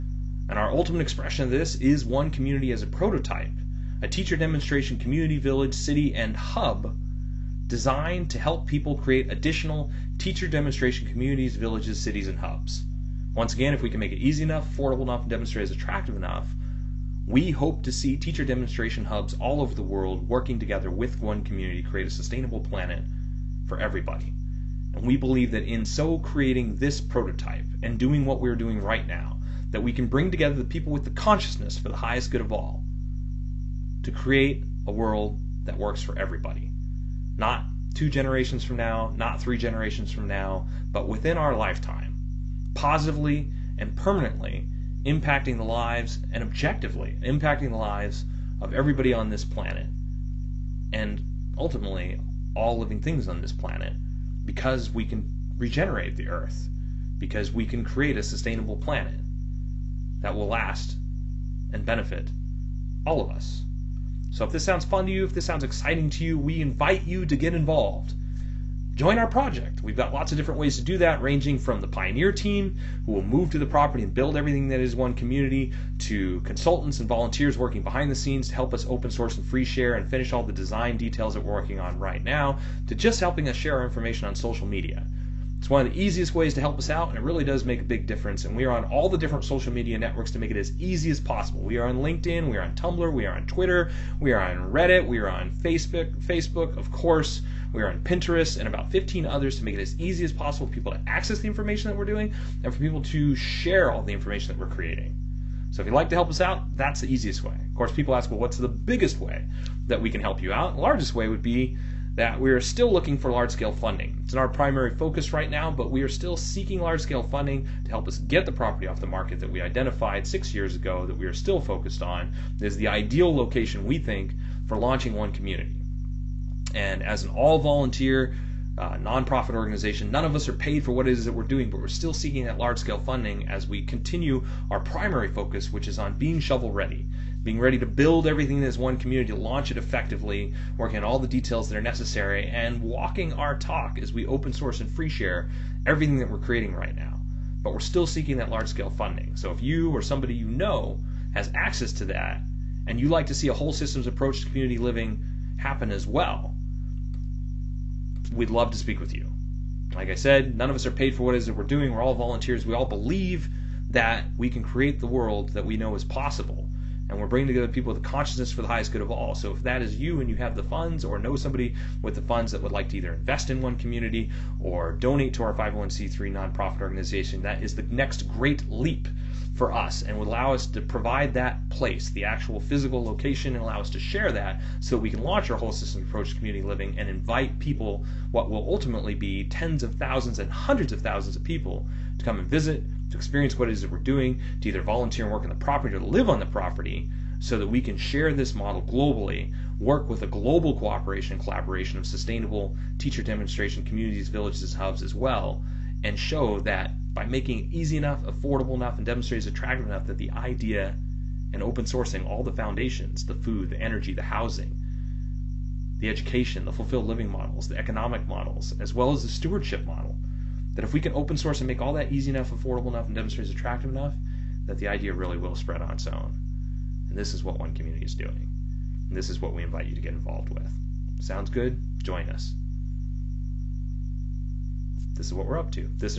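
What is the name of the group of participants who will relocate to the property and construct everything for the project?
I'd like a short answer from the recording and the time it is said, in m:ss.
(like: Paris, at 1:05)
Pioneer team, at 1:11.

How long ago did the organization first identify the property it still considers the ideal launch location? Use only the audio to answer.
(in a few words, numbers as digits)
6 years ago.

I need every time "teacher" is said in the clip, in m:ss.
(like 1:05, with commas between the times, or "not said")
0:04, 0:10, 0:18, 3:22.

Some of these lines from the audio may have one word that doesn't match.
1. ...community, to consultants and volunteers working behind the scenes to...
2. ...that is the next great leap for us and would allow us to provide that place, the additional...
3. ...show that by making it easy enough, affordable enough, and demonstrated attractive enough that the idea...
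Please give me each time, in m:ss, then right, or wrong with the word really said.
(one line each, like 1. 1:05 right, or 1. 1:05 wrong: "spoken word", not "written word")
1. 1:15 right
2. 2:57 wrong: "actual", not "additional"
3. 3:26 right.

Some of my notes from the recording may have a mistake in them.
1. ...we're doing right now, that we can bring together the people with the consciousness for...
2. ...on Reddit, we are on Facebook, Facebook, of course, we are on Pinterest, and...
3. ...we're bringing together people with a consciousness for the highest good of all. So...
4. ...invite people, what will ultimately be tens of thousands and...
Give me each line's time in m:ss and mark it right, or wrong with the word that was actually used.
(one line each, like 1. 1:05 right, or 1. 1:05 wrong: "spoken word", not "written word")
1. 0:28 right
2. 1:34 right
3. 2:47 right
4. 3:07 right.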